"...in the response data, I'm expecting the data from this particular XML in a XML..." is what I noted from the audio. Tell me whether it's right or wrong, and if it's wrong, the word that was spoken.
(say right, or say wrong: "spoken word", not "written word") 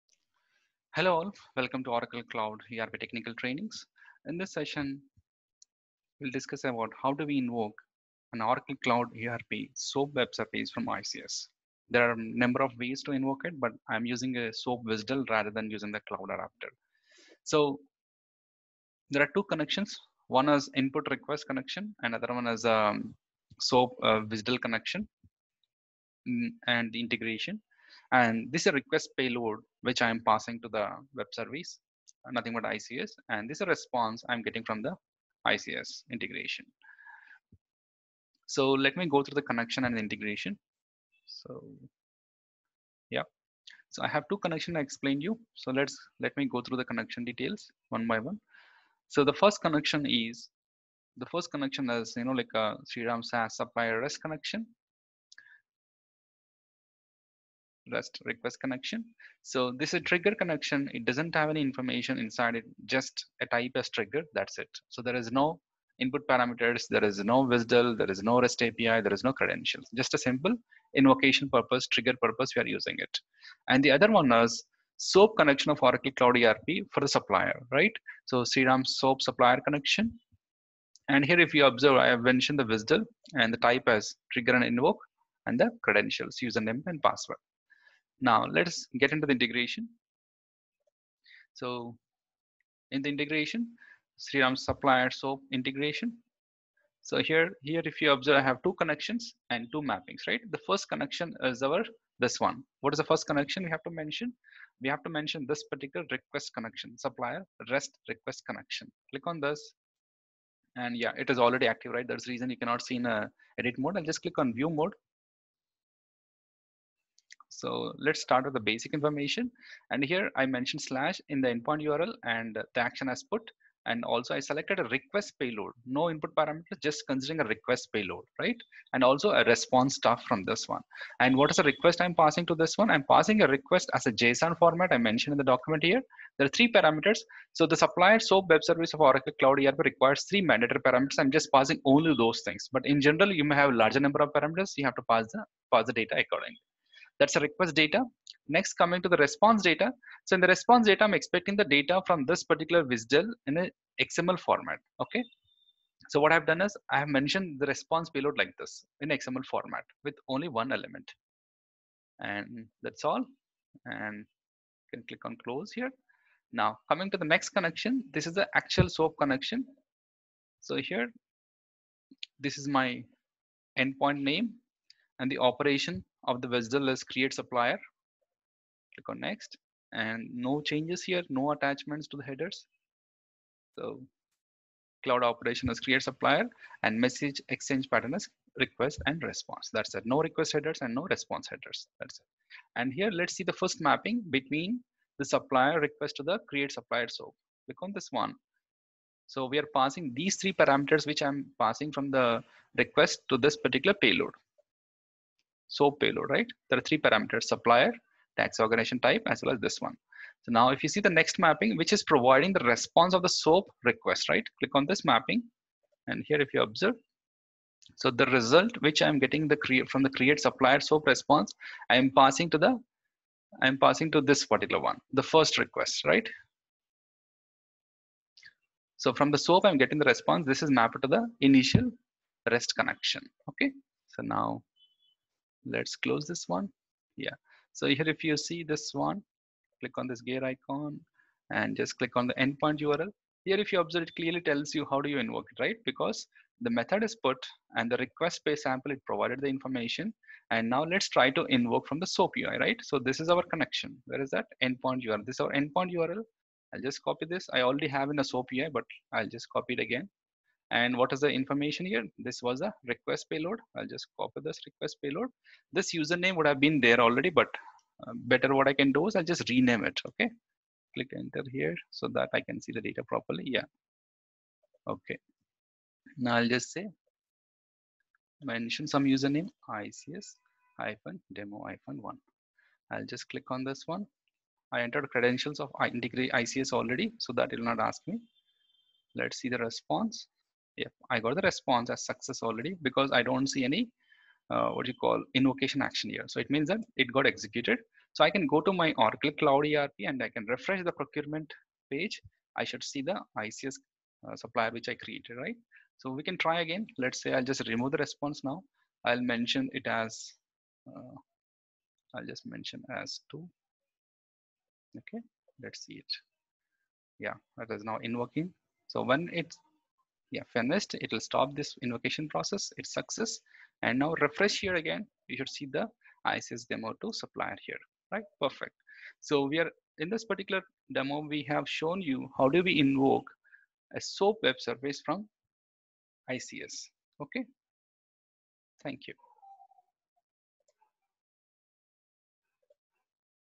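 wrong: "WSDL", not "XML".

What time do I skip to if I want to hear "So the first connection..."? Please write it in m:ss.
0:49.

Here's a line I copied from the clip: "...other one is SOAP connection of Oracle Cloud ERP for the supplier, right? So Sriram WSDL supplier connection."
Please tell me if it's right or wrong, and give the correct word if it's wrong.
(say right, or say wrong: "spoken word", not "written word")
wrong: "SOAP", not "WSDL".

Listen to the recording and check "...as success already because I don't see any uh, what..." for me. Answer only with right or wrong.
right.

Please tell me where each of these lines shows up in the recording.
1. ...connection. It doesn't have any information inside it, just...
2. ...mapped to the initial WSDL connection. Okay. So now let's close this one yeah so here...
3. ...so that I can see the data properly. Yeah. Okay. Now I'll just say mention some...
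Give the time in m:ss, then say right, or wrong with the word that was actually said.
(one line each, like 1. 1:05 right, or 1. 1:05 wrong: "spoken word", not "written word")
1. 1:00 right
2. 3:50 wrong: "REST", not "WSDL"
3. 4:31 right.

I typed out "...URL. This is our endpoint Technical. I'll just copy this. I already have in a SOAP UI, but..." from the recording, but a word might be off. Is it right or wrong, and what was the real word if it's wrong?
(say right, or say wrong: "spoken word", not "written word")
wrong: "URL", not "Technical".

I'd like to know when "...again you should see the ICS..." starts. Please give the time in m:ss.
5:24.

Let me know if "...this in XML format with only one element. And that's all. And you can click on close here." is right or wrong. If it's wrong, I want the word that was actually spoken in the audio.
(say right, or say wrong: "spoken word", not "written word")
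right.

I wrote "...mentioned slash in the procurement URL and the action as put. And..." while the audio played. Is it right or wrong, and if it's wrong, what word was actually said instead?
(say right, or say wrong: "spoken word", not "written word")
wrong: "endpoint", not "procurement".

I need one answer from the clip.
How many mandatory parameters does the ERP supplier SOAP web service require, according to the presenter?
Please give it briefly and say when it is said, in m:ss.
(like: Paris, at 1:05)
3, at 2:20.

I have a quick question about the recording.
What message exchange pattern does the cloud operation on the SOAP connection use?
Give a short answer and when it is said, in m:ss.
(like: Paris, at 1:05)
request and response, at 3:08.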